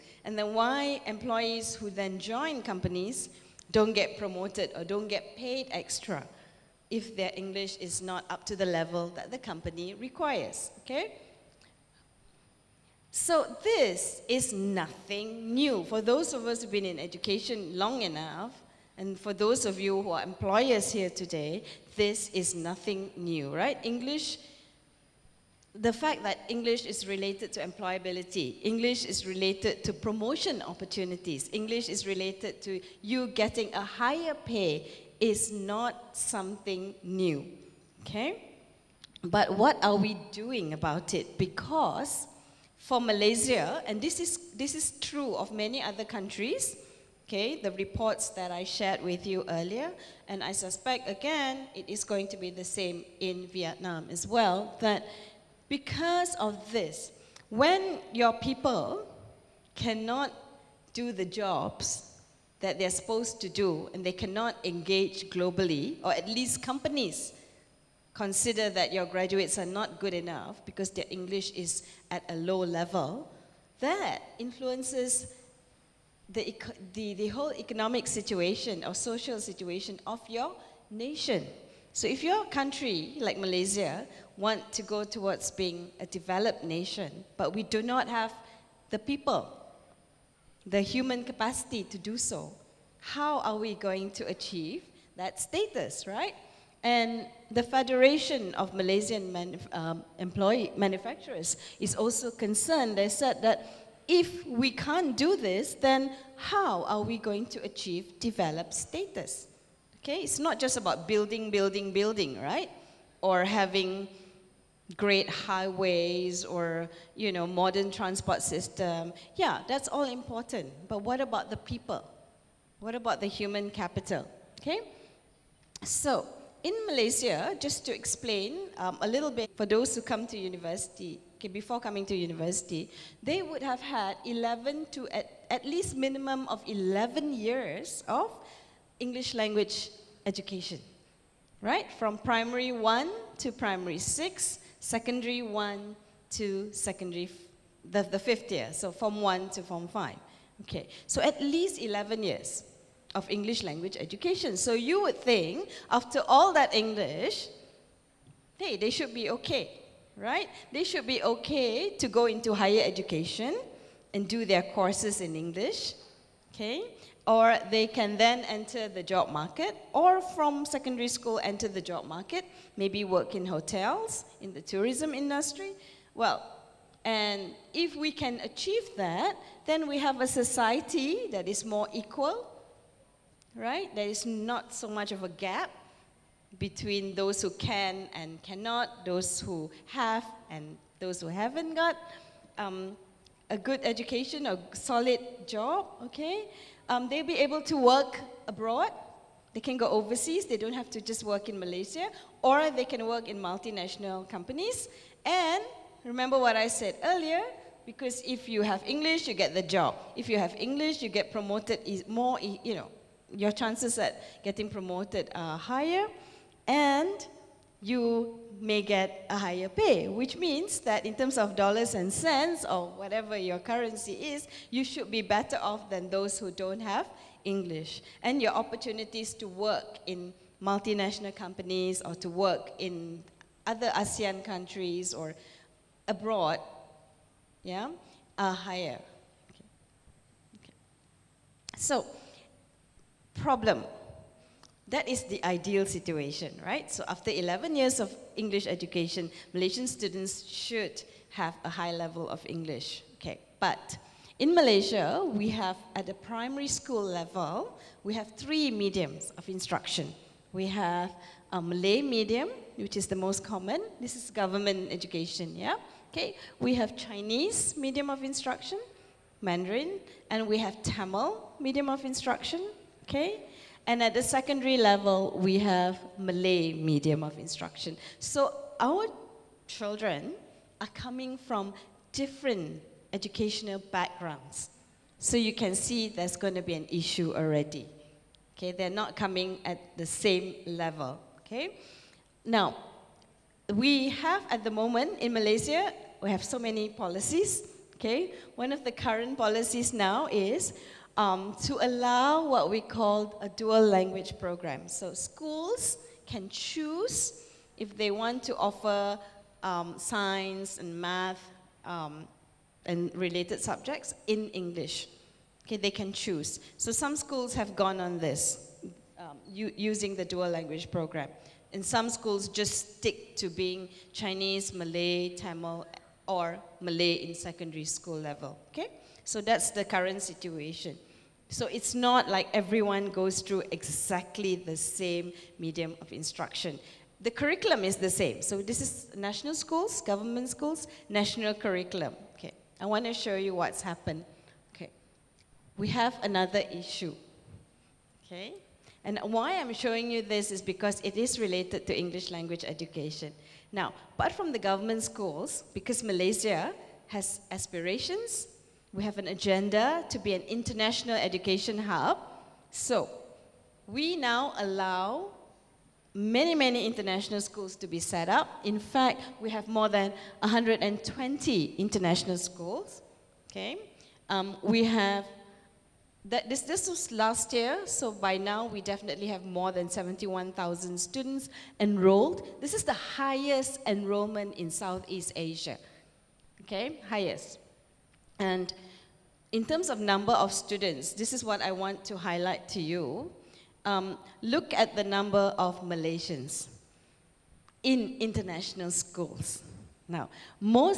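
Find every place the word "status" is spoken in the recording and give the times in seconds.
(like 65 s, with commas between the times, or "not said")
95 s, 108 s.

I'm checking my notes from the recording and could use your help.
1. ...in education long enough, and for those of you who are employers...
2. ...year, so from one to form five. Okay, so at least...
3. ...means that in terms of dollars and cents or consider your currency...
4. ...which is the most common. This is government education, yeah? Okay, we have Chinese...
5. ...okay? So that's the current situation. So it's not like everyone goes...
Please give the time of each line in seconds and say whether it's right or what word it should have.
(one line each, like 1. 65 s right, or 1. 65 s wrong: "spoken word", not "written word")
1. 16 s right
2. 148 s right
3. 220 s wrong: "whatever", not "consider"
4. 262 s right
5. 328 s right.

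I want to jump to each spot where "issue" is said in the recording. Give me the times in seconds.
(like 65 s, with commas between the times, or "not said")
286 s, 346 s.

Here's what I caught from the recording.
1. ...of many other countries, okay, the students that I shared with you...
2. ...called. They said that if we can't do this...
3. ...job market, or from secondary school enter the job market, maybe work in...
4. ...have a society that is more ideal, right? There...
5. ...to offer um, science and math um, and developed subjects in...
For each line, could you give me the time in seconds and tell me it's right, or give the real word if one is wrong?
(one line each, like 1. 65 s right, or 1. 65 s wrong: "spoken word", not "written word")
1. 45 s wrong: "reports", not "students"
2. 102 s wrong: "concerned", not "called"
3. 169 s right
4. 179 s wrong: "equal", not "ideal"
5. 308 s wrong: "related", not "developed".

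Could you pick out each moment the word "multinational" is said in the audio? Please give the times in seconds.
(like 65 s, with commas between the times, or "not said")
203 s, 230 s.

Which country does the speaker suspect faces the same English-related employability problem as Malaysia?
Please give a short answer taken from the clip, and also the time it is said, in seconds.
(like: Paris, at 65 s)
Vietnam, at 53 s.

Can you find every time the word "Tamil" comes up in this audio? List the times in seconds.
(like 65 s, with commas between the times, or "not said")
270 s, 325 s.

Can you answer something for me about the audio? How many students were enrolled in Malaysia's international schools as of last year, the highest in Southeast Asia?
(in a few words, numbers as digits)
71,000.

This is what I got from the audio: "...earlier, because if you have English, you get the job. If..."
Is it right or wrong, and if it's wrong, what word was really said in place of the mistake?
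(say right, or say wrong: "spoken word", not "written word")
right.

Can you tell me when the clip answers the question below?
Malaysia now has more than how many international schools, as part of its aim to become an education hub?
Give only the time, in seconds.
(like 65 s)
369 s.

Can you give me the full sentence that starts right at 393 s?
Um, look at the number of Malaysians in international schools.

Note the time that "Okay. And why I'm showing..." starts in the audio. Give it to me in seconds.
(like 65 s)
348 s.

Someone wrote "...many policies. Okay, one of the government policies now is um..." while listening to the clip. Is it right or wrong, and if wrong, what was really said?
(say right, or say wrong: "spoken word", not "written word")
wrong: "current", not "government".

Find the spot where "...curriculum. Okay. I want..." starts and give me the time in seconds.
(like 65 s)
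341 s.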